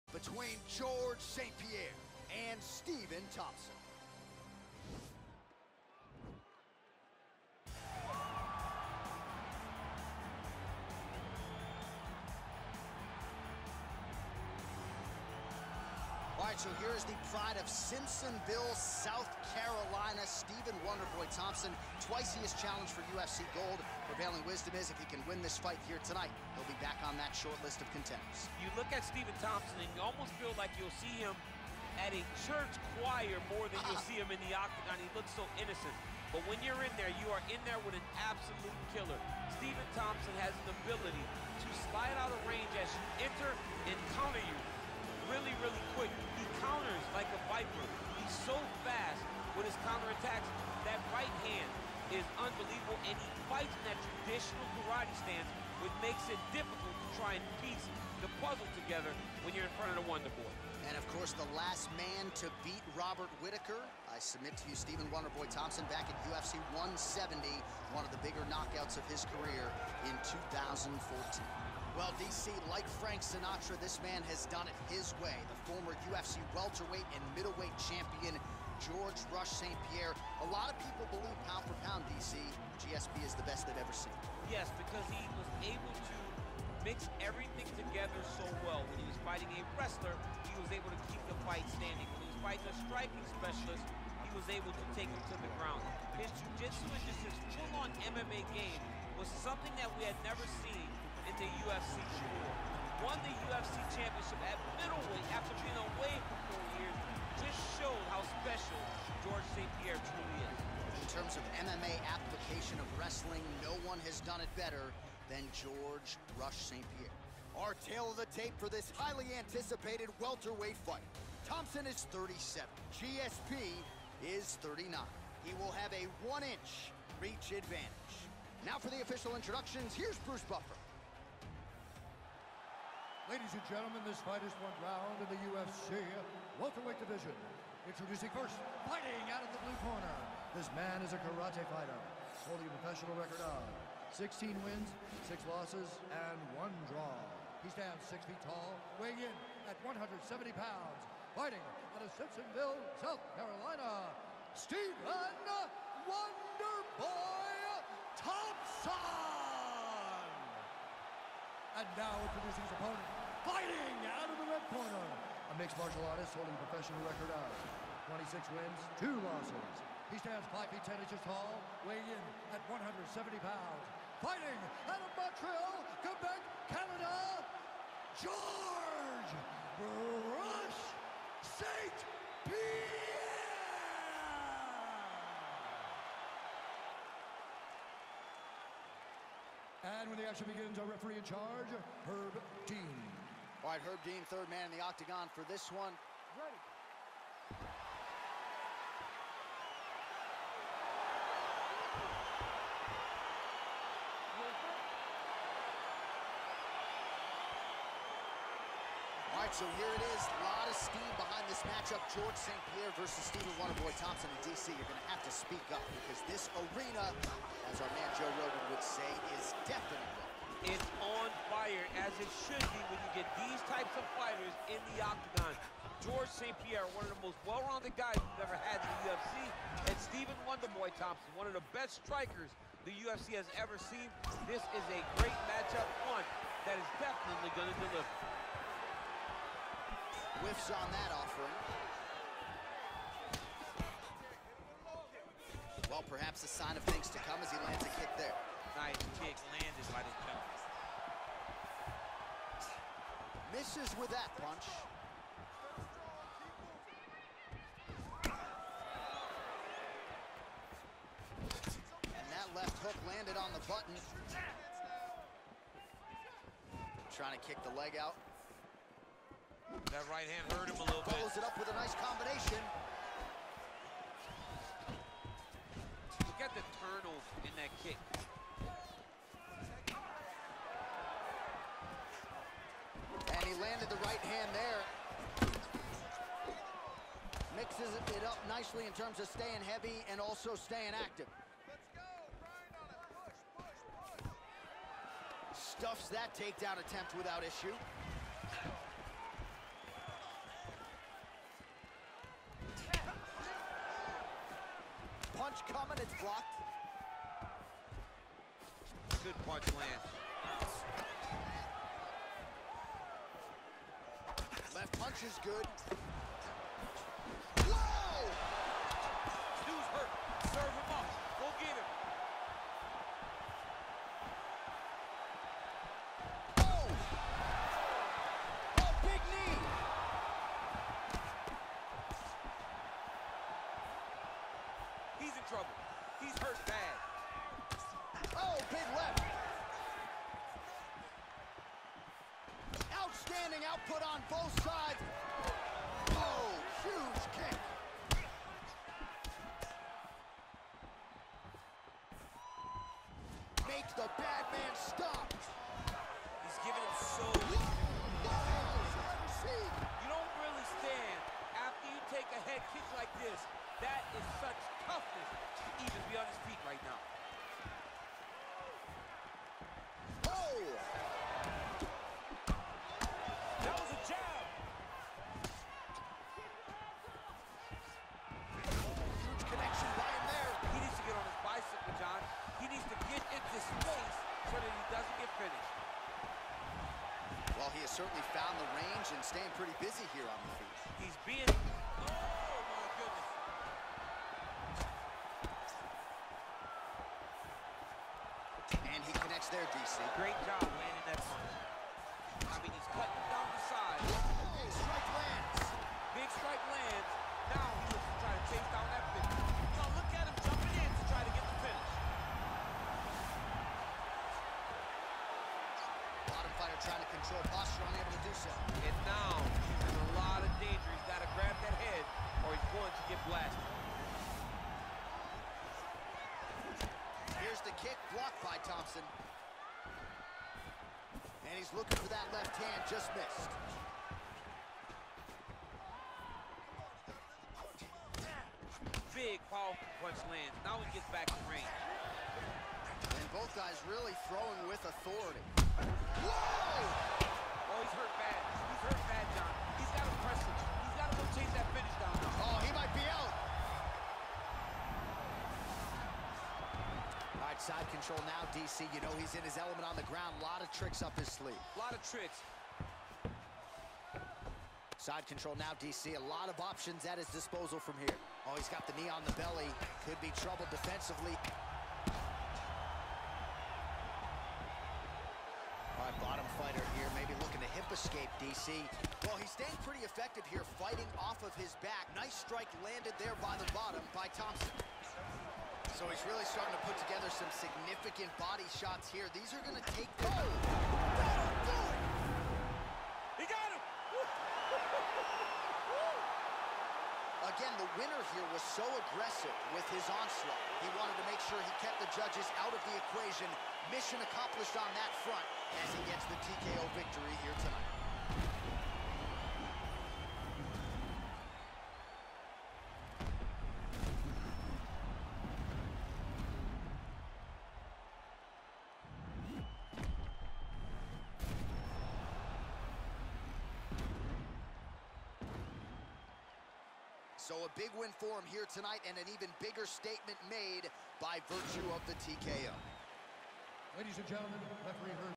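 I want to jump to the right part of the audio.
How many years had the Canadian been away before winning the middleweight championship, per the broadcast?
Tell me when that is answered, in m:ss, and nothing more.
1:46.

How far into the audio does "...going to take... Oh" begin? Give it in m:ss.
8:09.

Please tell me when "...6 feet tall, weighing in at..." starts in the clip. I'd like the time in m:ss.
2:28.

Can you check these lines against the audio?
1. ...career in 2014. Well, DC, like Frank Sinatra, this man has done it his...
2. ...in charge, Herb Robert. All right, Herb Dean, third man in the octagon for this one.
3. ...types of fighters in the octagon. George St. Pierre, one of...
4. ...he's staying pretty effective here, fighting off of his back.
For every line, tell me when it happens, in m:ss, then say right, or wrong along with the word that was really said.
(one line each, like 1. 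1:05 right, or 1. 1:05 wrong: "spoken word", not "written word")
1. 1:09 right
2. 3:11 wrong: "Dean", not "Robert"
3. 3:43 right
4. 7:59 right.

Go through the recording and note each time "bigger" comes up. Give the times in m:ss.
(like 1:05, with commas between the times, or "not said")
1:08, 8:49.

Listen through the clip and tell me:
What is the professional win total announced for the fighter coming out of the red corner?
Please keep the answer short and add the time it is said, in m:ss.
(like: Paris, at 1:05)
26, at 2:48.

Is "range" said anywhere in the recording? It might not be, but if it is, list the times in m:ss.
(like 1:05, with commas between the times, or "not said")
0:42, 6:28, 7:21.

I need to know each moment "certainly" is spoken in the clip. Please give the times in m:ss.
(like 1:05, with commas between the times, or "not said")
6:27.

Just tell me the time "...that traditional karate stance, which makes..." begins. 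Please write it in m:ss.
0:53.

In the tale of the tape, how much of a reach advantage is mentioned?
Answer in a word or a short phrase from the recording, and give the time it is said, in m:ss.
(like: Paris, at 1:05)
1 inch, at 2:06.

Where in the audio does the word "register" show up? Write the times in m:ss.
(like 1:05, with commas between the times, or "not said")
not said.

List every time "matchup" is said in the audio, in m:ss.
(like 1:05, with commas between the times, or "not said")
3:31, 3:55.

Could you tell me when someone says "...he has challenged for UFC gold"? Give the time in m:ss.
0:22.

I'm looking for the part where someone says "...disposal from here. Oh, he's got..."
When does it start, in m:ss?
7:47.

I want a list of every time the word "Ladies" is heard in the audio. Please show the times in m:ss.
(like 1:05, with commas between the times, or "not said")
2:13, 8:53.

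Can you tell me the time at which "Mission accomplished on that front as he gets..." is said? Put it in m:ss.
8:23.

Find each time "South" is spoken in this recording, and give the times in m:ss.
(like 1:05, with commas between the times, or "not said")
0:18, 2:32.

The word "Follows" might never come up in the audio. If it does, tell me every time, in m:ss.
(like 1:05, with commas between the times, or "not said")
4:31.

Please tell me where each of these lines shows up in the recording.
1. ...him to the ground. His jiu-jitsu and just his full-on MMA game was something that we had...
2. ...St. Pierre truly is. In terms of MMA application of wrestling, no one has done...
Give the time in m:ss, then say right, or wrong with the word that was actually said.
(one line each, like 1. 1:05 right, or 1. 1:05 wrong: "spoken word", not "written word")
1. 1:35 right
2. 1:49 right.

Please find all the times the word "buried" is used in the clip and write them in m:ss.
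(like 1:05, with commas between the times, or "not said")
not said.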